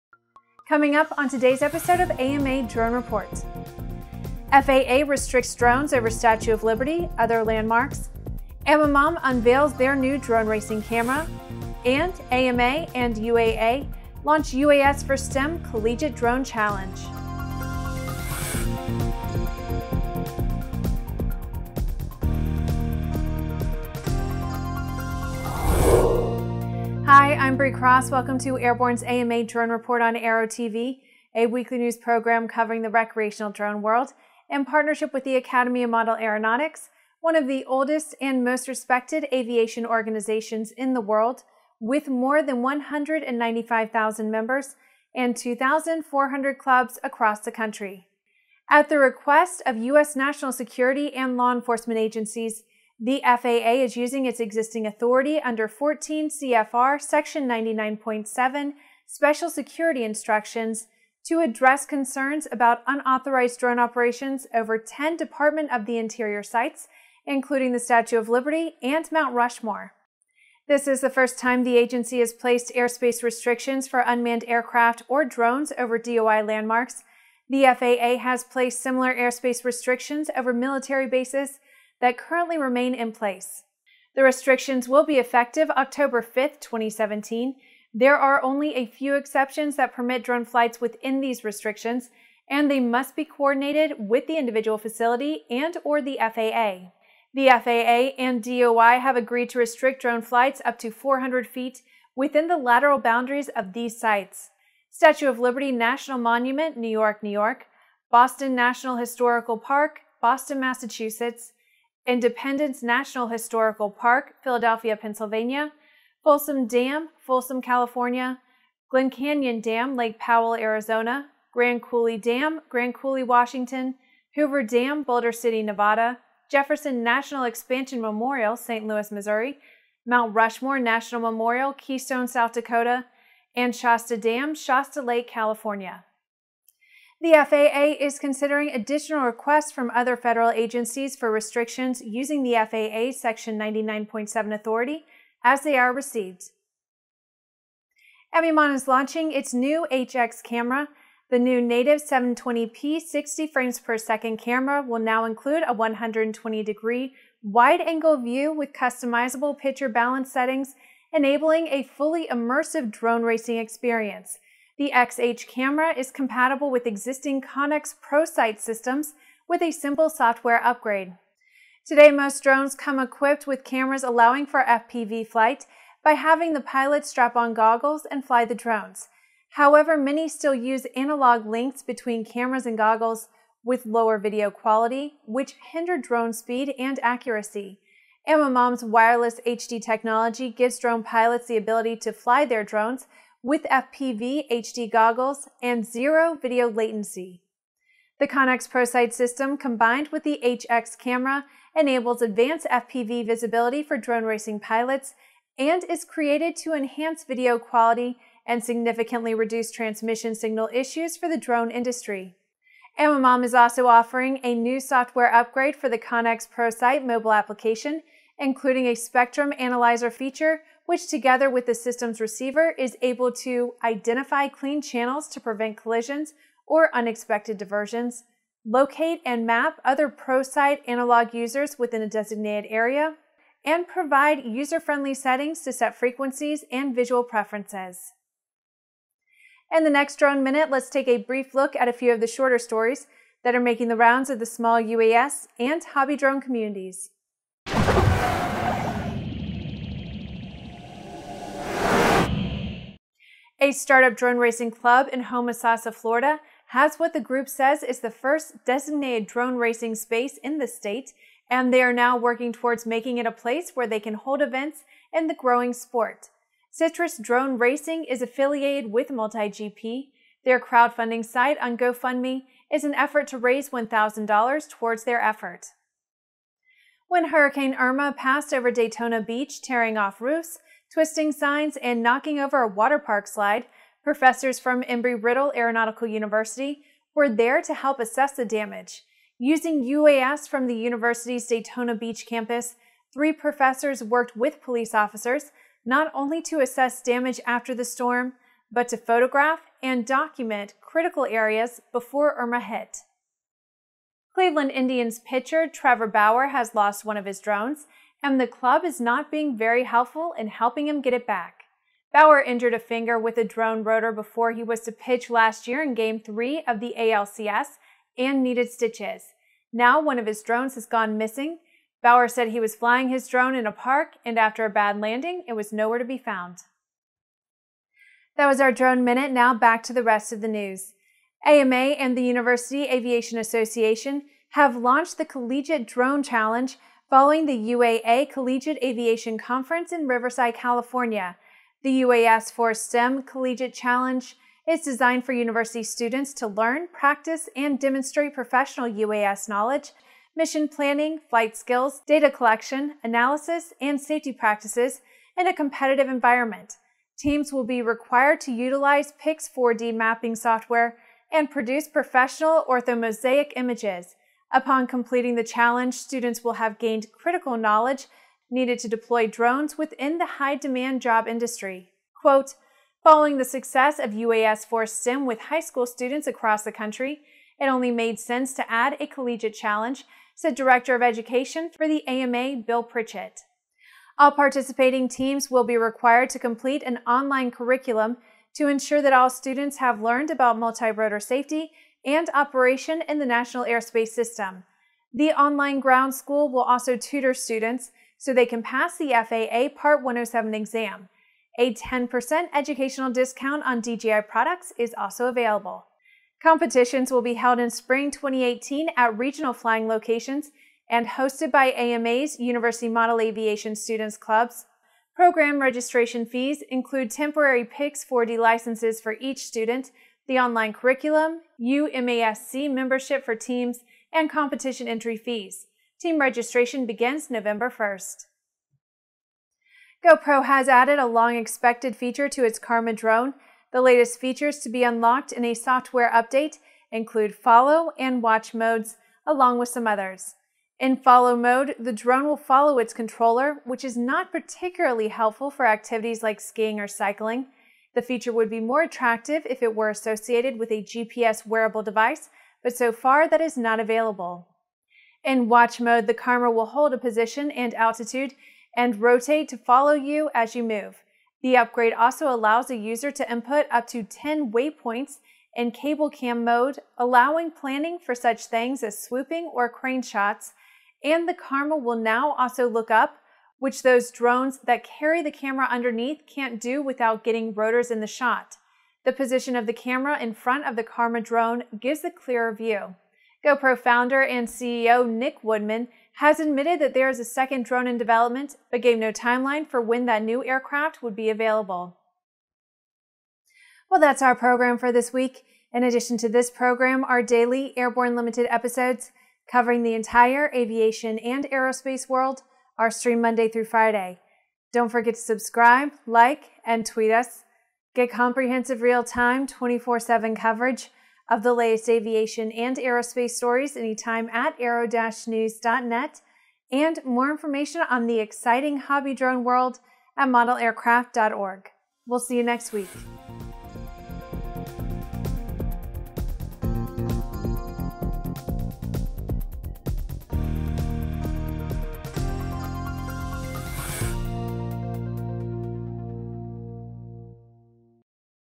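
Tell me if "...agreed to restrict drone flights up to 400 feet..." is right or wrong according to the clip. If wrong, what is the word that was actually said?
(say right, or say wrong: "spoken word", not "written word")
right.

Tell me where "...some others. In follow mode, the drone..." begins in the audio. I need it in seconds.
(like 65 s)
439 s.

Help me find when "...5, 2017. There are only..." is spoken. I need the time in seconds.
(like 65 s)
86 s.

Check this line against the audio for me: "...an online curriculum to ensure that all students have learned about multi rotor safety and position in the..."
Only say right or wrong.
wrong.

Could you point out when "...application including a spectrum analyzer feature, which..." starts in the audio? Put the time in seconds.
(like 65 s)
217 s.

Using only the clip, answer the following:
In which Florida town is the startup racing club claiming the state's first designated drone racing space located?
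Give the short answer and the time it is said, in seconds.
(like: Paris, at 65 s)
Homosassa, at 255 s.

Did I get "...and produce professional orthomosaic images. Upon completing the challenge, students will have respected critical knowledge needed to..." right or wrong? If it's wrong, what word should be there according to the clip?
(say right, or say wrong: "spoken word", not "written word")
wrong: "gained", not "respected".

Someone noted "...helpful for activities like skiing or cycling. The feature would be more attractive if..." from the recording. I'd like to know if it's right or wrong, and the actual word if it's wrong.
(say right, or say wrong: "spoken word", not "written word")
right.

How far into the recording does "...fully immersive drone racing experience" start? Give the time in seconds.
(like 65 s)
161 s.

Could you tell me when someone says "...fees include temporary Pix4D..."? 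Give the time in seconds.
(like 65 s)
416 s.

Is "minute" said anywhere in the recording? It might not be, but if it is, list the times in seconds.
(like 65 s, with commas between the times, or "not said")
240 s, 329 s.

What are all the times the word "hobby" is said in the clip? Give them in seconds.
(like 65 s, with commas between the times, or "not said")
245 s, 518 s.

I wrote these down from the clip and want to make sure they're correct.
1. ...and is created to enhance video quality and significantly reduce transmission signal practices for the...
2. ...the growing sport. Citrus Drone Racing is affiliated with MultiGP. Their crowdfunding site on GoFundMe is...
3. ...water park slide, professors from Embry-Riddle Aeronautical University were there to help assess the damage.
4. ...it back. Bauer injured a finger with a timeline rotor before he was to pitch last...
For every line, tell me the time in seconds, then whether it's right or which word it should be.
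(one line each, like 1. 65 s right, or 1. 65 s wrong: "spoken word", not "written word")
1. 205 s wrong: "issues", not "practices"
2. 265 s right
3. 282 s right
4. 311 s wrong: "drone", not "timeline".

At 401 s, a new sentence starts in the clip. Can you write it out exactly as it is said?
A 10% educational discount on DJI products is also available.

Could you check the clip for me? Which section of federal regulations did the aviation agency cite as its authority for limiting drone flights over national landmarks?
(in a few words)
14 CFR Section 99.7.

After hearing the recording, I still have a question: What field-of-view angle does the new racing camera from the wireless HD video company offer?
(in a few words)
120 degrees.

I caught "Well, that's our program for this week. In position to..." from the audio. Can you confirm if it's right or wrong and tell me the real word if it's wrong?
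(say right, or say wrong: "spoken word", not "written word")
wrong: "addition", not "position".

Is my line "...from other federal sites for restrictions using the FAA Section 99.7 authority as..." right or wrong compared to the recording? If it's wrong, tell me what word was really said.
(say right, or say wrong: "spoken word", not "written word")
wrong: "agencies", not "sites".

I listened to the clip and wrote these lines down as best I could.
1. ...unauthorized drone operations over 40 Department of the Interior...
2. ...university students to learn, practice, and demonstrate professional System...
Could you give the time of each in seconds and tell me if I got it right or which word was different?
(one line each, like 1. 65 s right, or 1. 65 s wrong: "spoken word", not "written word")
1. 62 s wrong: "10", not "40"
2. 345 s wrong: "UAS", not "System".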